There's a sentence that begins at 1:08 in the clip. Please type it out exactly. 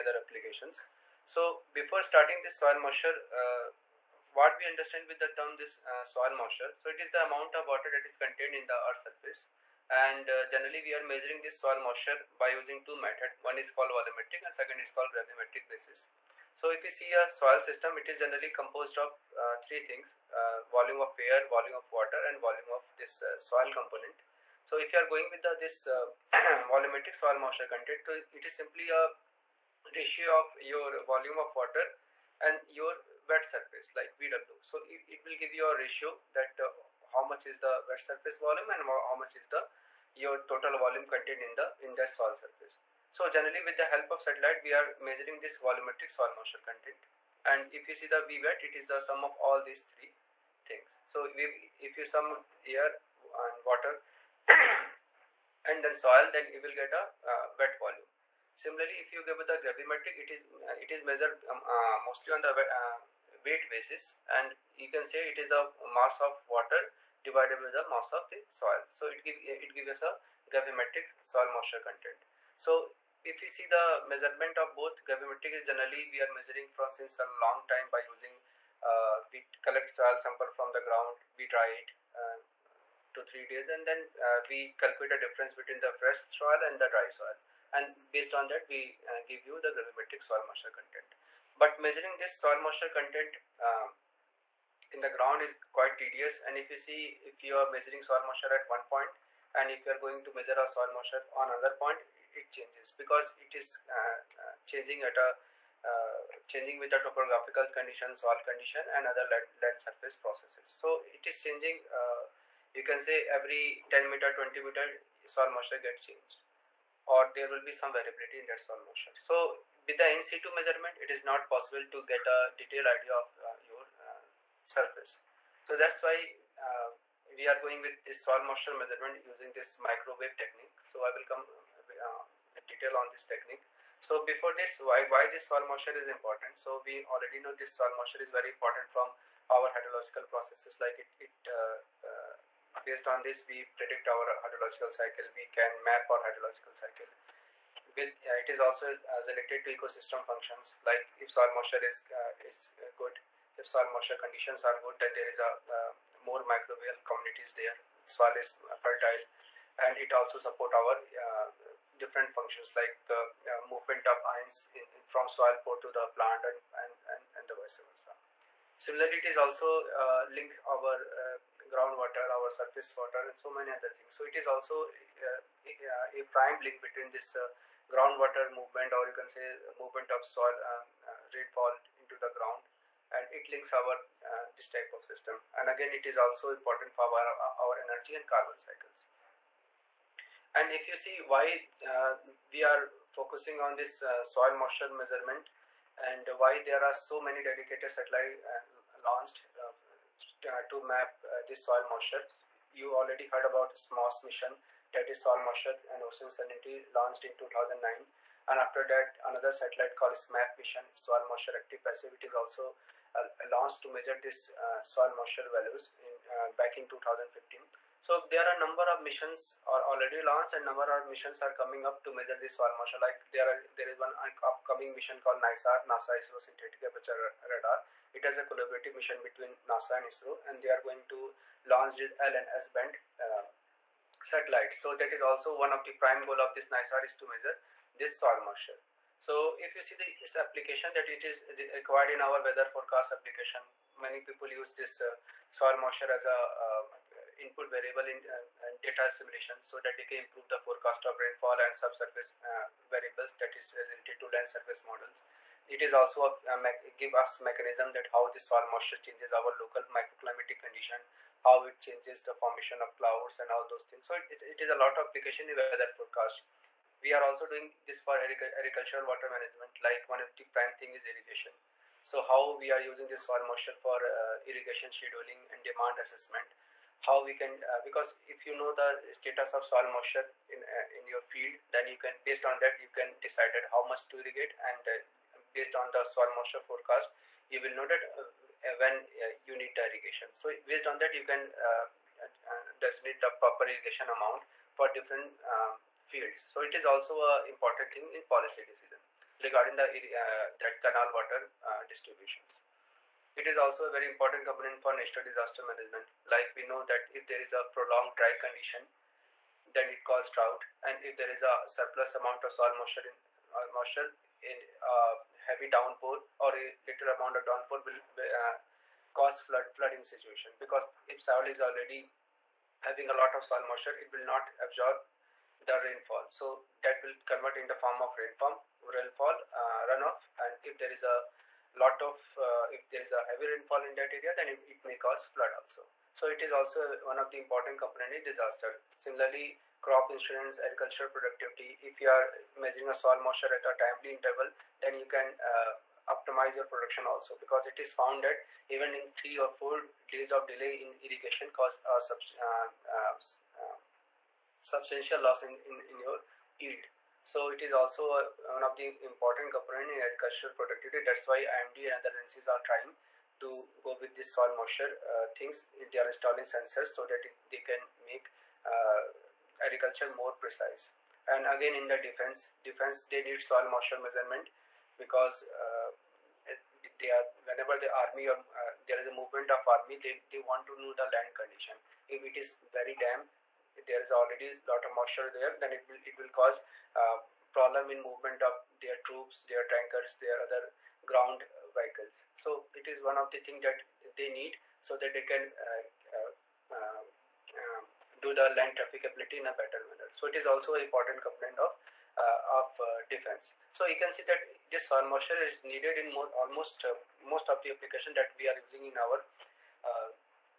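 So it give it gives us a gravimetric soil moisture content.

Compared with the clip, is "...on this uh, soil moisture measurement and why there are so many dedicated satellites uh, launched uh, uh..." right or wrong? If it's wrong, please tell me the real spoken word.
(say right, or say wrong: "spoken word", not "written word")
right.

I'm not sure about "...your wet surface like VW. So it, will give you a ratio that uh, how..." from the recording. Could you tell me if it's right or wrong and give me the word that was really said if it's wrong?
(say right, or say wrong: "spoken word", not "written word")
right.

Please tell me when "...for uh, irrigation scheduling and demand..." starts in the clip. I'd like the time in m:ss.
4:33.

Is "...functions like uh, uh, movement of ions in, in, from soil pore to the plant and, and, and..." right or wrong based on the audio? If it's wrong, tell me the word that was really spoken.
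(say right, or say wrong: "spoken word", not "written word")
right.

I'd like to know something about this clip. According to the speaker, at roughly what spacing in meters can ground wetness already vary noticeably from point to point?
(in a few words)
10 to 20 meters.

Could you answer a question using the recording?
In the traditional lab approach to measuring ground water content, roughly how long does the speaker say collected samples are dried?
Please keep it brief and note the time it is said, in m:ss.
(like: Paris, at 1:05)
2-3 days, at 1:23.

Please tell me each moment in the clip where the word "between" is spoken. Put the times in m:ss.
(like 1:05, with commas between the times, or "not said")
1:25, 2:56, 3:49.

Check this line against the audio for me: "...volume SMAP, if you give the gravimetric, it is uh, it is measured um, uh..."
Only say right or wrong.
wrong.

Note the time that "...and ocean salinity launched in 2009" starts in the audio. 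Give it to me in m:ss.
3:25.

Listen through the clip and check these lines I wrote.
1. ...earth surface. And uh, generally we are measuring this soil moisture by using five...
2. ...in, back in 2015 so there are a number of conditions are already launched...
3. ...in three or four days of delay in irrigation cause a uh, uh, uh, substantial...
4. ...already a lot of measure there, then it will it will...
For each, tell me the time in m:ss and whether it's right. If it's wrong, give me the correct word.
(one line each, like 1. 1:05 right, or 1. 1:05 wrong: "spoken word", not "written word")
1. 0:08 wrong: "two", not "five"
2. 3:36 wrong: "missions", not "conditions"
3. 5:48 right
4. 6:24 wrong: "moisture", not "measure".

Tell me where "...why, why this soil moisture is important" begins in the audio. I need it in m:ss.
2:14.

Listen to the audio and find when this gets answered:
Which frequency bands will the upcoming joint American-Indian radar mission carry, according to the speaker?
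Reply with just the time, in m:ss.
3:52.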